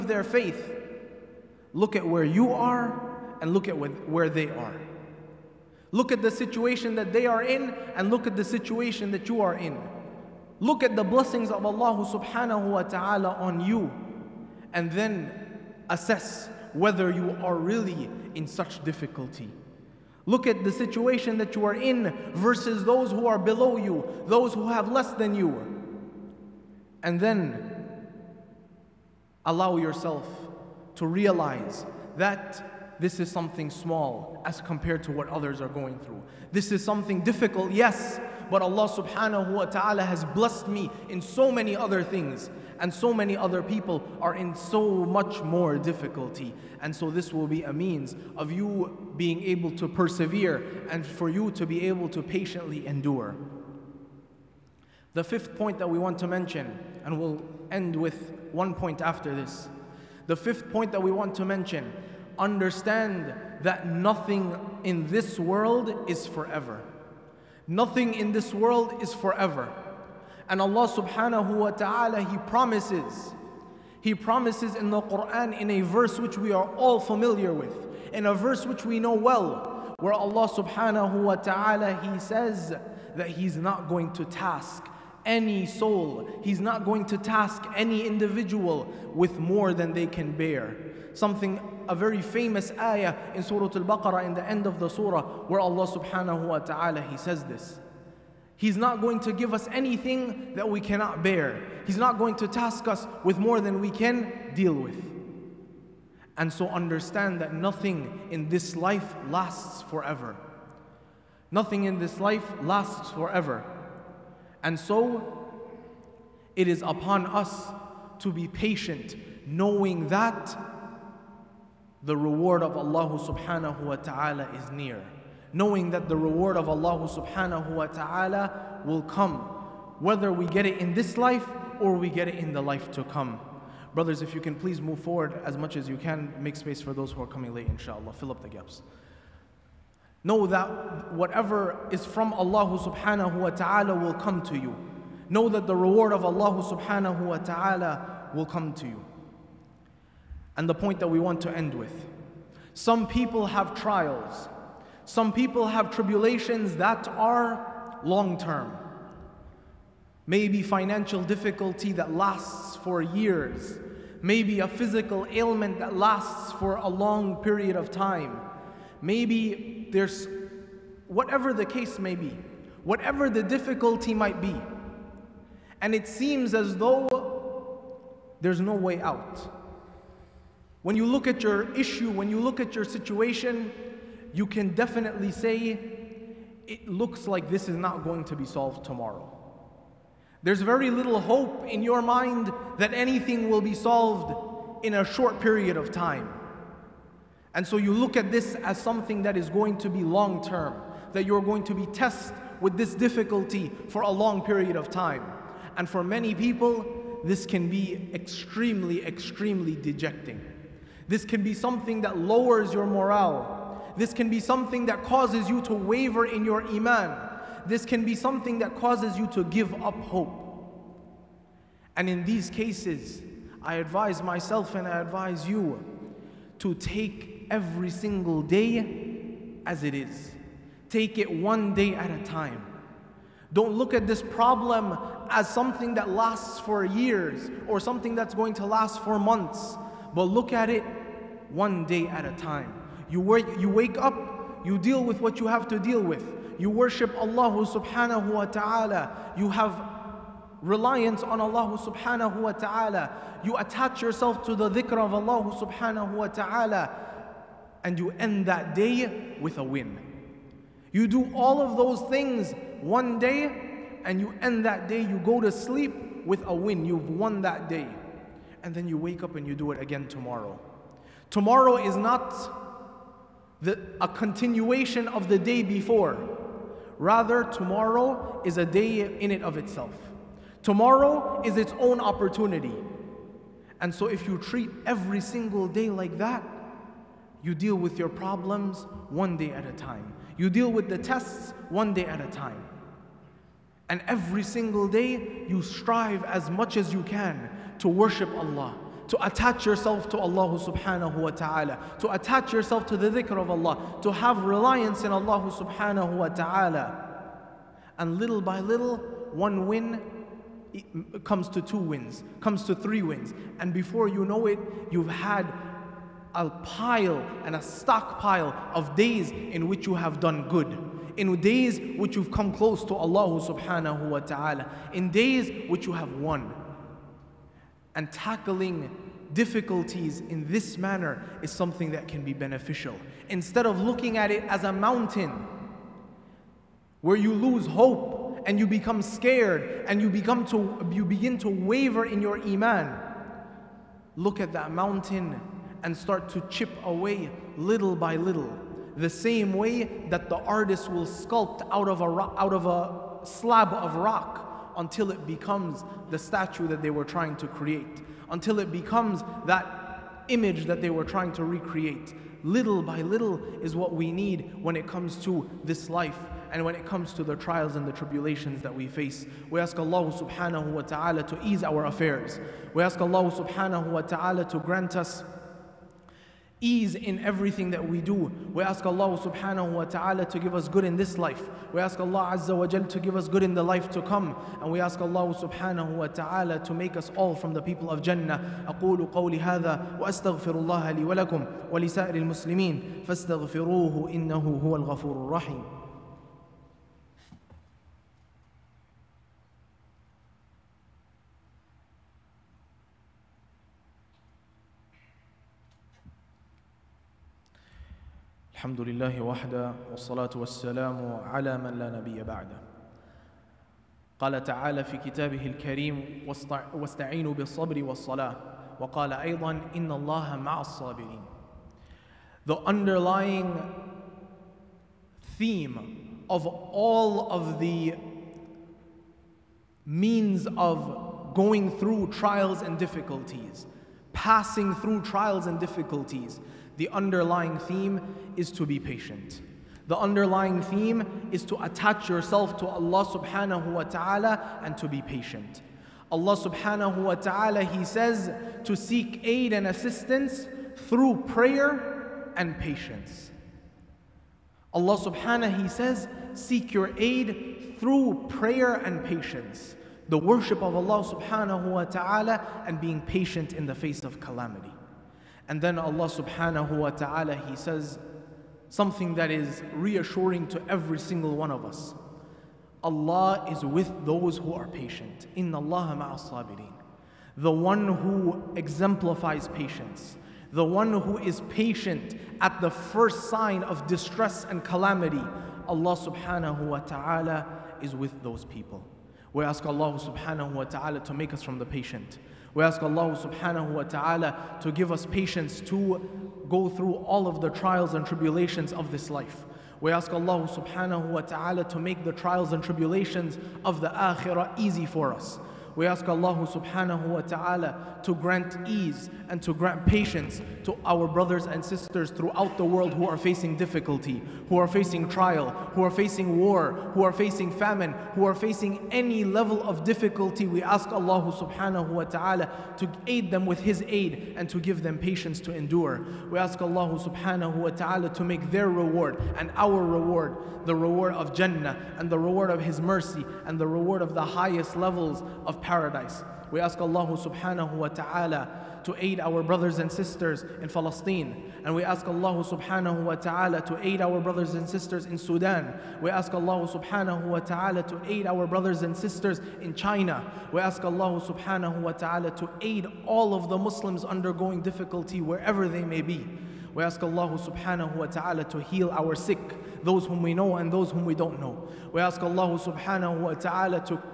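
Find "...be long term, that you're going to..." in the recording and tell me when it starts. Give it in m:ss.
3:19.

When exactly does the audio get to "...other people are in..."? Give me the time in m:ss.
0:43.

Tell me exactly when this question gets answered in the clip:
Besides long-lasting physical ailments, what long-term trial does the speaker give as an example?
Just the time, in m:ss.
2:40.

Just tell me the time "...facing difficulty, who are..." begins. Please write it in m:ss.
8:33.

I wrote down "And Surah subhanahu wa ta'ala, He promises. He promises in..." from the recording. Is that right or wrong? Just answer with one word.
wrong.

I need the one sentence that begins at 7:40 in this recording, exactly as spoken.
The worship of Allah subhanahu wa ta'ala and being patient in the face of calamity.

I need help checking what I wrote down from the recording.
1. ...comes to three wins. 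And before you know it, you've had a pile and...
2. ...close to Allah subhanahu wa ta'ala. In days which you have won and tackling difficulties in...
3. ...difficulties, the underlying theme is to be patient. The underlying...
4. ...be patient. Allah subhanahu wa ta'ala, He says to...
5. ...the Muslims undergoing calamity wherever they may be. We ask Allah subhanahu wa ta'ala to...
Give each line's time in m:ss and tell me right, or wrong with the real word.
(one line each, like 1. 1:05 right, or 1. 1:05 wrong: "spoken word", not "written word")
1. 5:12 right
2. 5:22 right
3. 7:15 right
4. 7:24 right
5. 9:13 wrong: "difficulty", not "calamity".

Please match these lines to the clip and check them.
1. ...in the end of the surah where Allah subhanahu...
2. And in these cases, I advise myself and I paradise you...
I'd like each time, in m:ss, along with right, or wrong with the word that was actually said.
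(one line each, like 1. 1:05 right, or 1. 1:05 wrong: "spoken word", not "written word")
1. 1:34 right
2. 3:41 wrong: "advise", not "paradise".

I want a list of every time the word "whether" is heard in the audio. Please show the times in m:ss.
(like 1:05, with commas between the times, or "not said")
0:16, 2:09.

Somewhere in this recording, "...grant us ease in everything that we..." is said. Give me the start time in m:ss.
6:14.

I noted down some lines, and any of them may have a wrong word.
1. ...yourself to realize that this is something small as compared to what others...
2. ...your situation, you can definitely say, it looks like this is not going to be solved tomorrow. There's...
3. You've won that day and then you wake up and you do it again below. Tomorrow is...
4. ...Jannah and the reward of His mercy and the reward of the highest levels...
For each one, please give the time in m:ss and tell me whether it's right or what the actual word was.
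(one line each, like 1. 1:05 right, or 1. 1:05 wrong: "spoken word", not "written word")
1. 0:29 right
2. 3:02 right
3. 4:26 wrong: "tomorrow", not "below"
4. 8:51 right.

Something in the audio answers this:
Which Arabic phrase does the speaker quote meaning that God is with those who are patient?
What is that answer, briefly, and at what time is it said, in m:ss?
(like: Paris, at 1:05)
In Allah ma'as-sabirin, at 7:55.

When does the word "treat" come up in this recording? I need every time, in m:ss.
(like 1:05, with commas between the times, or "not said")
4:44.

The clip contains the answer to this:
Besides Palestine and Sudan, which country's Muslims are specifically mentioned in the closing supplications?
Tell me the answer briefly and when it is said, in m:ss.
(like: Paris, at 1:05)
China, at 9:09.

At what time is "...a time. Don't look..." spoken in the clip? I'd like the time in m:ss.
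3:52.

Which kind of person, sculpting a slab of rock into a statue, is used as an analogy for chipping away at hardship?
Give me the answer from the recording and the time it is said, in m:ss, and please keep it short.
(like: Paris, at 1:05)
The artist, at 5:50.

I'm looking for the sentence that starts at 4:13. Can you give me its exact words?
You attach yourself to the dhikr of Allah subhanahu wa ta'ala.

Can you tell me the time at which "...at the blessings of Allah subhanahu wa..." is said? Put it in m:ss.
0:10.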